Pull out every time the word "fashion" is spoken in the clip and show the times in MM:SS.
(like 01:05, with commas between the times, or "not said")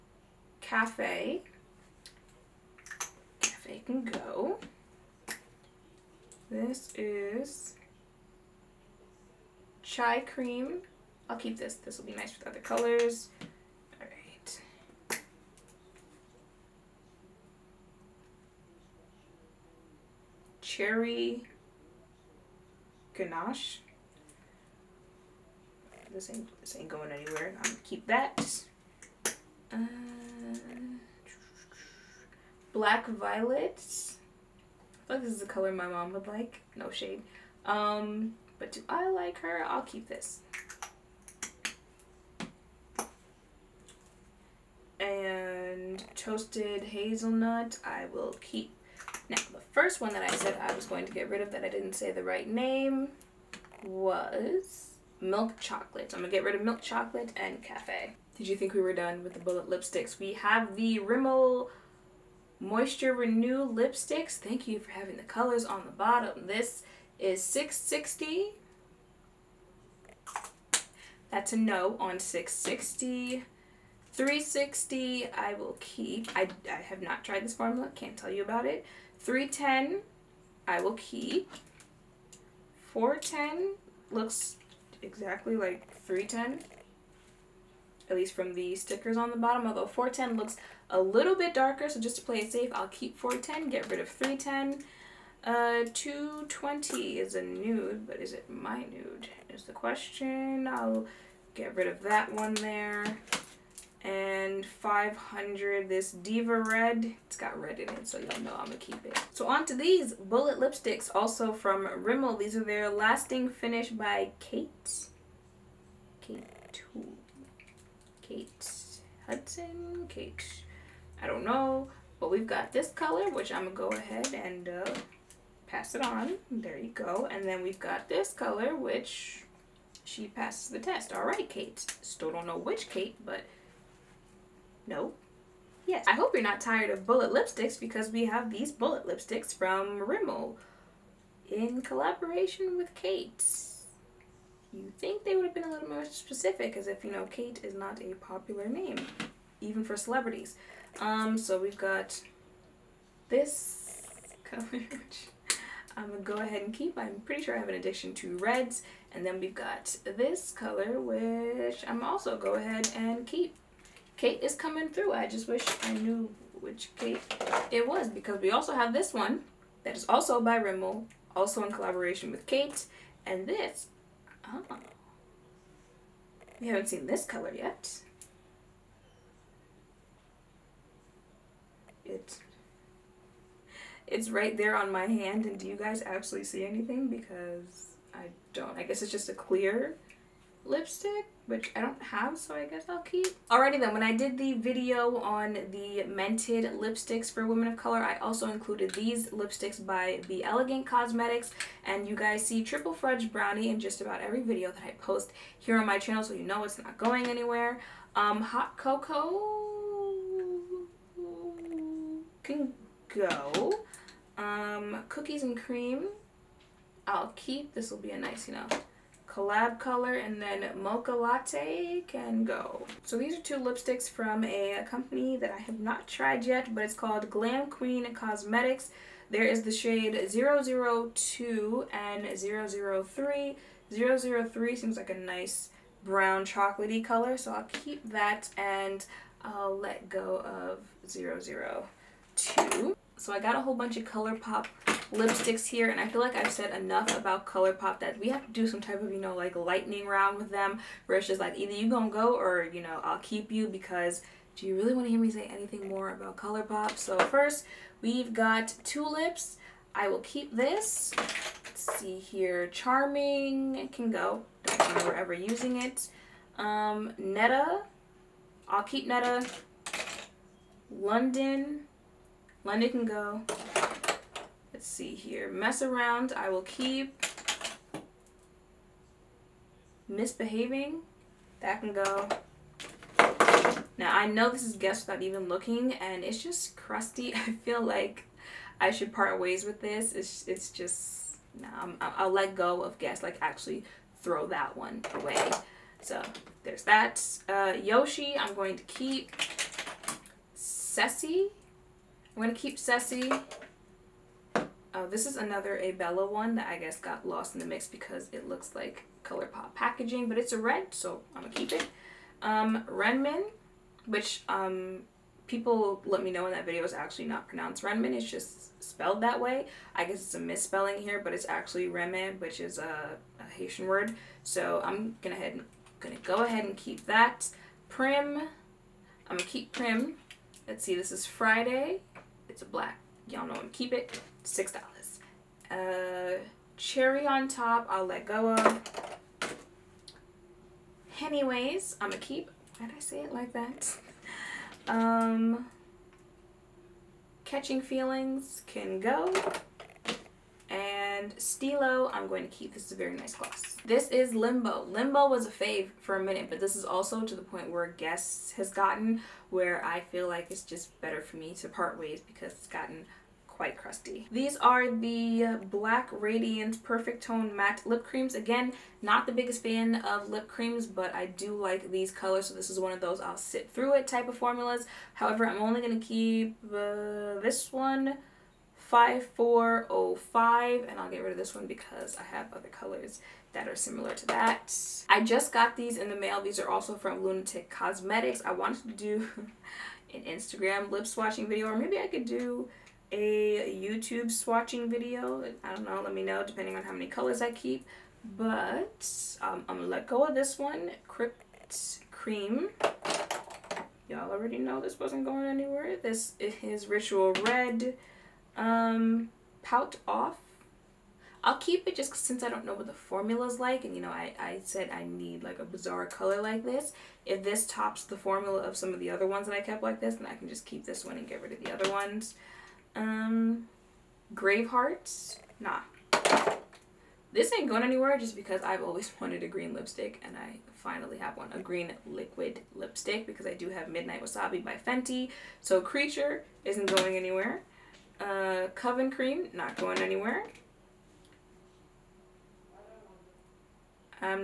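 not said.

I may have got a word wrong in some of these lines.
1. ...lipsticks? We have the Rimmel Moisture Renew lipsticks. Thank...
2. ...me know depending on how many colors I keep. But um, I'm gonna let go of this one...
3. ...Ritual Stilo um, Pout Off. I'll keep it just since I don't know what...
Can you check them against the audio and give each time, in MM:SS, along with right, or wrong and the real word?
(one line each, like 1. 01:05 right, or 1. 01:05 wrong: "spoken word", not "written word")
1. 00:59 right
2. 06:36 right
3. 06:46 wrong: "Red", not "Stilo".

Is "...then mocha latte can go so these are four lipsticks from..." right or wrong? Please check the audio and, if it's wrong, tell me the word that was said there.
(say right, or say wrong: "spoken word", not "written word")
wrong: "two", not "four".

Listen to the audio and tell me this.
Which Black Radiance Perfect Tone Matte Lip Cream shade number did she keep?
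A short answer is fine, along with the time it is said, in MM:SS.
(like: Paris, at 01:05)
5405, at 06:18.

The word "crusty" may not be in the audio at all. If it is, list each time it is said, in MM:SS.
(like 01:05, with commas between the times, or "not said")
04:46, 06:03.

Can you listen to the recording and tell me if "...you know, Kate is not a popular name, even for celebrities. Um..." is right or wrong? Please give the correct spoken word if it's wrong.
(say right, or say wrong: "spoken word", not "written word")
right.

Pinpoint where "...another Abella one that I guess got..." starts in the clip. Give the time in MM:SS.
05:05.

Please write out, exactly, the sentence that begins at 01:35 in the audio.
Uh, 220 is a nude, but is it my nude is the question.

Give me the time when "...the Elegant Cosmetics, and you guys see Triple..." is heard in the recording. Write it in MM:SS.
03:20.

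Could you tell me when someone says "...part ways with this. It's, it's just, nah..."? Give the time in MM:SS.
04:49.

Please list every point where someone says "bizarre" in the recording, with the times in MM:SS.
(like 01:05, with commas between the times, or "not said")
06:55.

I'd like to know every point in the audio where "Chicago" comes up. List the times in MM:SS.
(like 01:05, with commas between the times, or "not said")
not said.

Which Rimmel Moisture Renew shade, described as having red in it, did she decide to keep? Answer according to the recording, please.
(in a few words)
Diva red.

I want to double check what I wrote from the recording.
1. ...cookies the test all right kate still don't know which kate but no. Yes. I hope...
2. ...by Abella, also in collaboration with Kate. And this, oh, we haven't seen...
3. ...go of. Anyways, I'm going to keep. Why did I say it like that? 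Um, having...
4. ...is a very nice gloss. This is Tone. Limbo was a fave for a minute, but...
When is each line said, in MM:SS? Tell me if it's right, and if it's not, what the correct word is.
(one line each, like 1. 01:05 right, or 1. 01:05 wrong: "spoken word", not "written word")
1. 02:10 wrong: "passes", not "cookies"
2. 02:50 wrong: "Rimmel", not "Abella"
3. 05:38 wrong: "catching", not "having"
4. 05:52 wrong: "Limbo", not "Tone".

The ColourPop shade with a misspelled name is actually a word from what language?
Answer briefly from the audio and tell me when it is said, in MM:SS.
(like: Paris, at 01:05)
Haitian, at 05:23.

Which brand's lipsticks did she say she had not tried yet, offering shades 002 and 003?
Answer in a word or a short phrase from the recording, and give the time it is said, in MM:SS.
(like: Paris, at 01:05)
Glam Queen Cosmetics, at 03:47.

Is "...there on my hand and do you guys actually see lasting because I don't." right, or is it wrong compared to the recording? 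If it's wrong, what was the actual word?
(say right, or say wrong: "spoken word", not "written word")
wrong: "anything", not "lasting".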